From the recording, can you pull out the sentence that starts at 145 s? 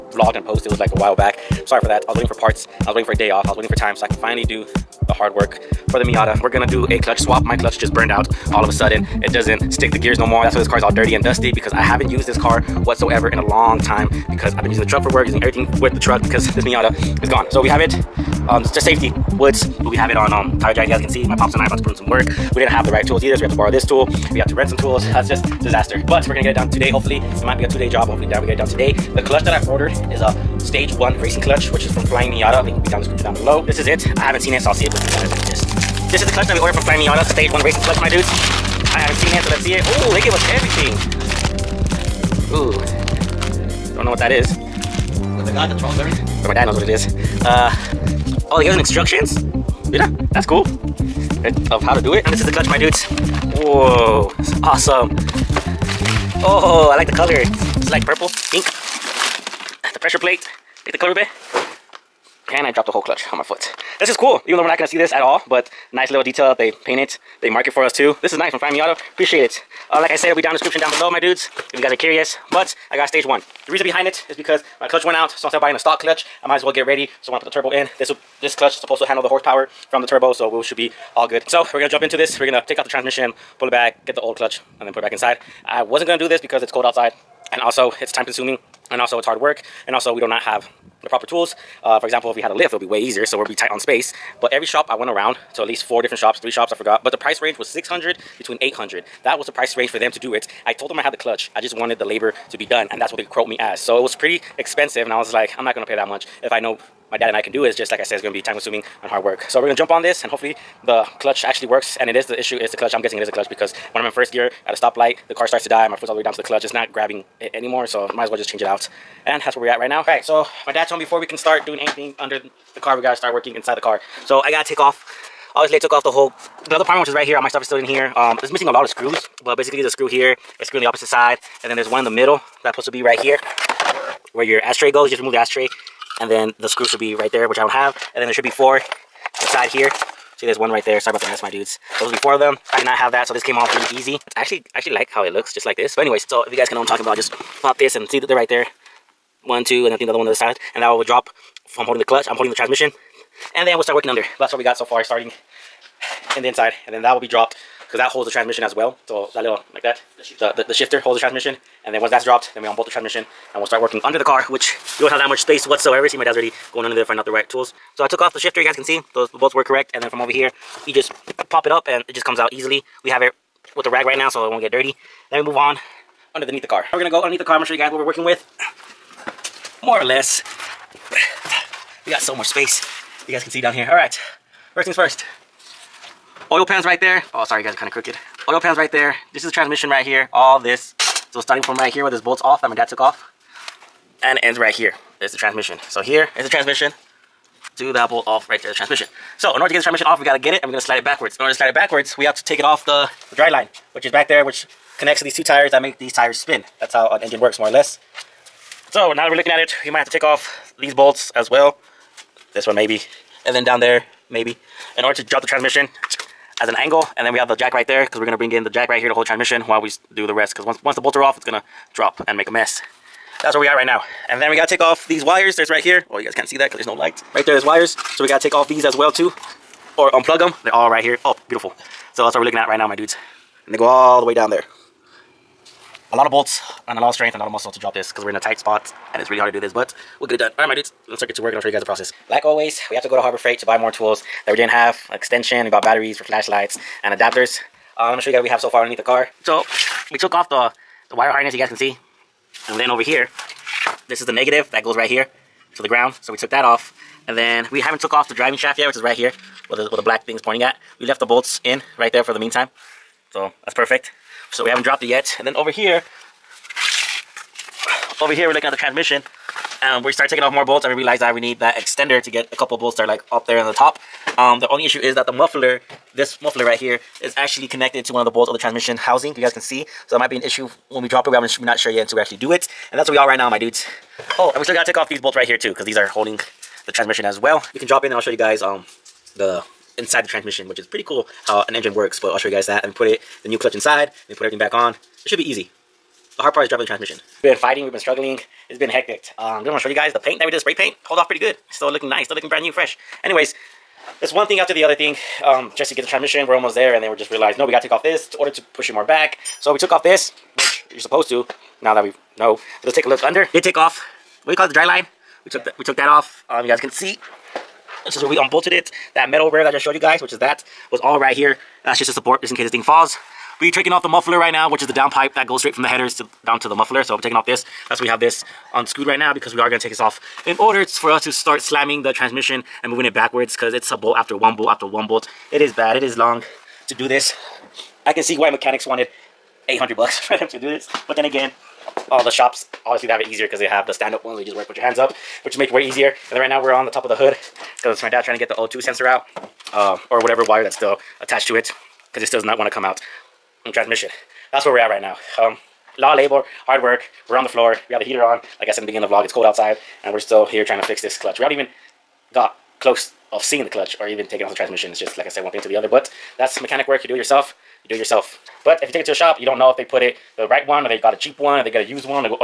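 But anyways, so if you guys can know what I'm talking about, just pop this and see that they're right there.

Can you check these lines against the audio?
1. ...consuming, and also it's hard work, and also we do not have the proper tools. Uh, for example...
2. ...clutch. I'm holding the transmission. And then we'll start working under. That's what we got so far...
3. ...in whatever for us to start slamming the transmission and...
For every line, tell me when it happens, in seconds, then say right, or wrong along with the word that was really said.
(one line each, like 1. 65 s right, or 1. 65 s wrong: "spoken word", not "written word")
1. 88 s right
2. 152 s right
3. 330 s wrong: "order", not "whatever".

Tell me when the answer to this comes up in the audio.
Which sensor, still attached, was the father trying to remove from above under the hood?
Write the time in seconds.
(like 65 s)
348 s.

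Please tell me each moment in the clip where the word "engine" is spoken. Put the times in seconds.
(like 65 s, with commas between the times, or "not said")
207 s, 291 s.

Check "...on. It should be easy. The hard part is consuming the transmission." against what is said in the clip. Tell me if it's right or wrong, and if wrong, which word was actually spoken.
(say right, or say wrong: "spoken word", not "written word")
wrong: "dropping", not "consuming".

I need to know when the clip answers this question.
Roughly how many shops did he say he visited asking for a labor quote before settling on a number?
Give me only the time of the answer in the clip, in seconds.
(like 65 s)
96 s.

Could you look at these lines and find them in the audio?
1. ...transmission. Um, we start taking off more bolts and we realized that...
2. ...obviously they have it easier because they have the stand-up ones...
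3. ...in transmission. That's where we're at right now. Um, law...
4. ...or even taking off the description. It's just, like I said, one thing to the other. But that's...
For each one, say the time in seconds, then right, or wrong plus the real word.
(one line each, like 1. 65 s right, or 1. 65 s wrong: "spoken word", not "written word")
1. 268 s right
2. 342 s right
3. 353 s right
4. 364 s wrong: "transmission", not "description".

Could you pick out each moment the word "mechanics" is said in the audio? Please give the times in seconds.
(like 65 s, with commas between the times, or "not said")
338 s, 366 s.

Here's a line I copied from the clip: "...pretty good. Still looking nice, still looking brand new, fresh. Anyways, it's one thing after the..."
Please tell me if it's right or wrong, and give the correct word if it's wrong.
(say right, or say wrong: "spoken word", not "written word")
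right.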